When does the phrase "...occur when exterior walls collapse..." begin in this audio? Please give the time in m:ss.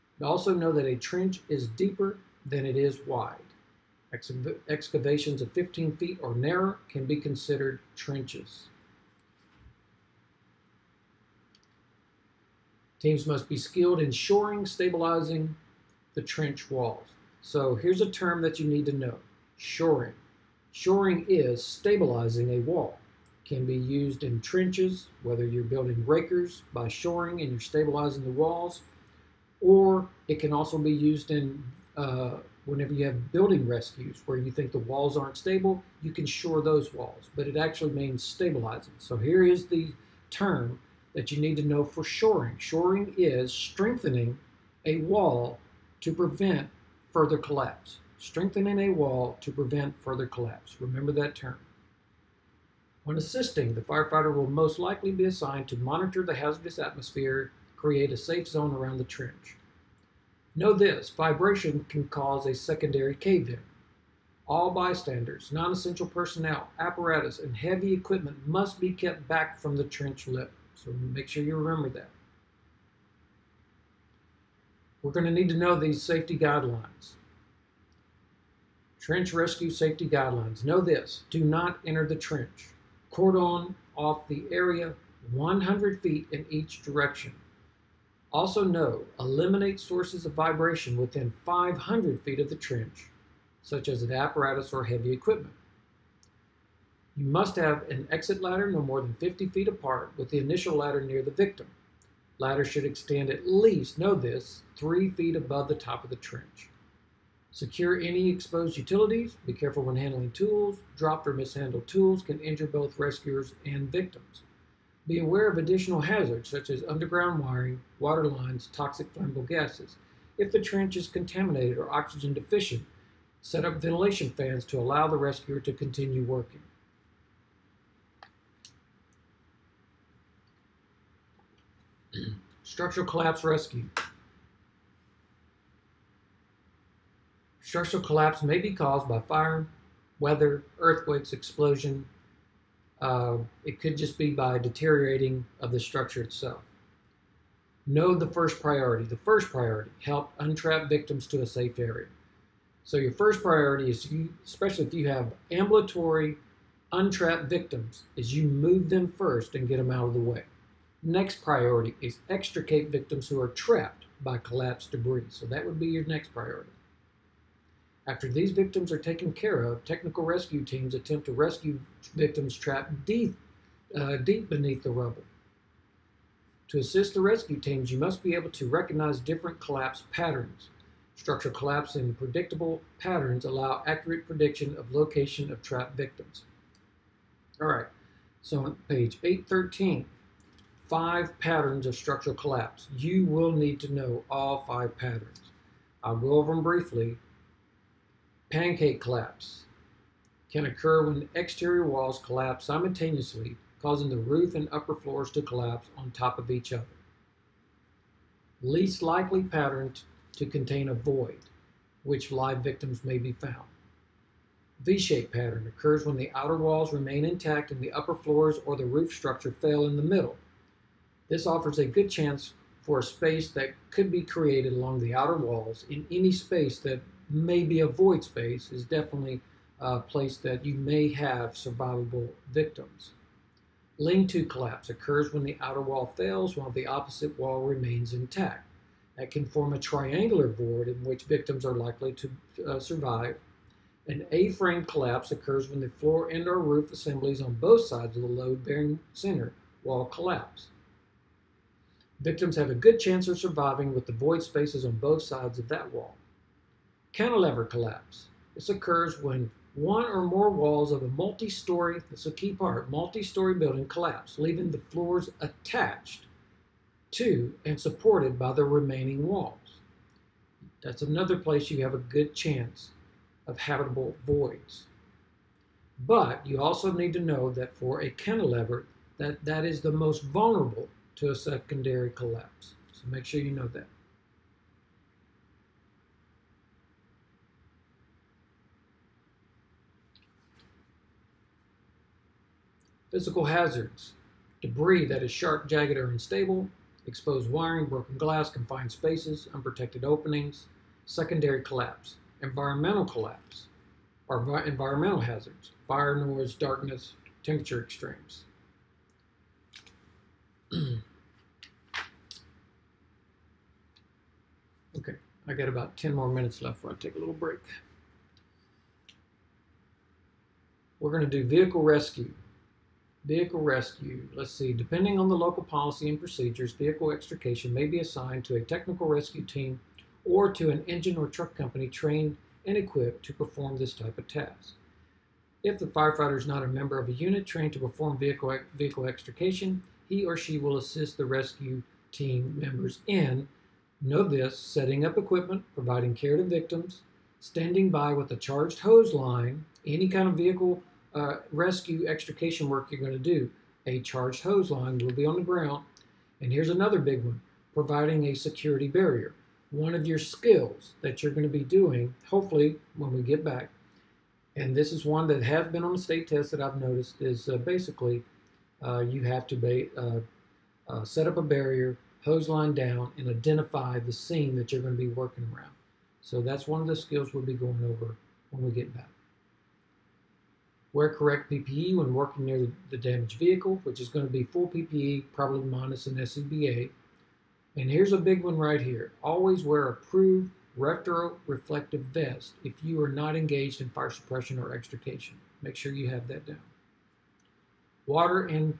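3:20.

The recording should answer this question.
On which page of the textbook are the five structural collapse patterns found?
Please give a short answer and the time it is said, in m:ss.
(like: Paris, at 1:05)
813, at 3:09.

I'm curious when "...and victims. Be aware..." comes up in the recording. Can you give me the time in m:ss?
1:53.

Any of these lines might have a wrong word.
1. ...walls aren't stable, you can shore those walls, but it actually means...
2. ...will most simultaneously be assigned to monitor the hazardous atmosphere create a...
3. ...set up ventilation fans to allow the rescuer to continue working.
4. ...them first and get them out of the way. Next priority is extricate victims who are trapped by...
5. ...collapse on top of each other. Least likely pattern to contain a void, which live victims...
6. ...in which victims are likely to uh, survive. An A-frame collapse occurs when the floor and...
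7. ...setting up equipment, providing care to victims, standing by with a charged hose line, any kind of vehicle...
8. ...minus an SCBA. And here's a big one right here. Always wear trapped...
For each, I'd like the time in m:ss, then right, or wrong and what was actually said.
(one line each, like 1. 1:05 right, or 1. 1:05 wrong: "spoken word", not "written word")
1. 0:34 right
2. 0:54 wrong: "likely", not "simultaneously"
3. 2:03 right
4. 2:38 right
5. 3:25 right
6. 4:00 right
7. 5:44 right
8. 6:25 wrong: "approved", not "trapped".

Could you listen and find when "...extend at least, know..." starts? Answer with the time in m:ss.
1:42.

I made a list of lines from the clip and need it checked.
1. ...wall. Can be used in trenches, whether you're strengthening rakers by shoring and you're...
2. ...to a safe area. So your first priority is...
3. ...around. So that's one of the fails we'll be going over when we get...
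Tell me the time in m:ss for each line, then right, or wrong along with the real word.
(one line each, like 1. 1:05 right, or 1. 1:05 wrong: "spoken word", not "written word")
1. 0:22 wrong: "building", not "strengthening"
2. 2:31 right
3. 6:15 wrong: "skills", not "fails".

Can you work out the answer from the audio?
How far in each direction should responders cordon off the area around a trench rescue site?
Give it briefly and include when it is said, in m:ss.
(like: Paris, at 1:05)
100 feet, at 1:25.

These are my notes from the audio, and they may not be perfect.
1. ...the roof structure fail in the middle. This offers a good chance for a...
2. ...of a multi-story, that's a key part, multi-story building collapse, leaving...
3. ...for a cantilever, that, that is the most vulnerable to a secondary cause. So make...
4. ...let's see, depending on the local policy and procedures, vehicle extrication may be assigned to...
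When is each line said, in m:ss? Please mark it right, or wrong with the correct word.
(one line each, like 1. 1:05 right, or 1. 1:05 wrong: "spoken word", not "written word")
1. 3:38 right
2. 4:20 right
3. 4:37 wrong: "collapse", not "cause"
4. 5:24 right.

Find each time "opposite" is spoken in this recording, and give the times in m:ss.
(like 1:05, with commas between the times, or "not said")
3:56.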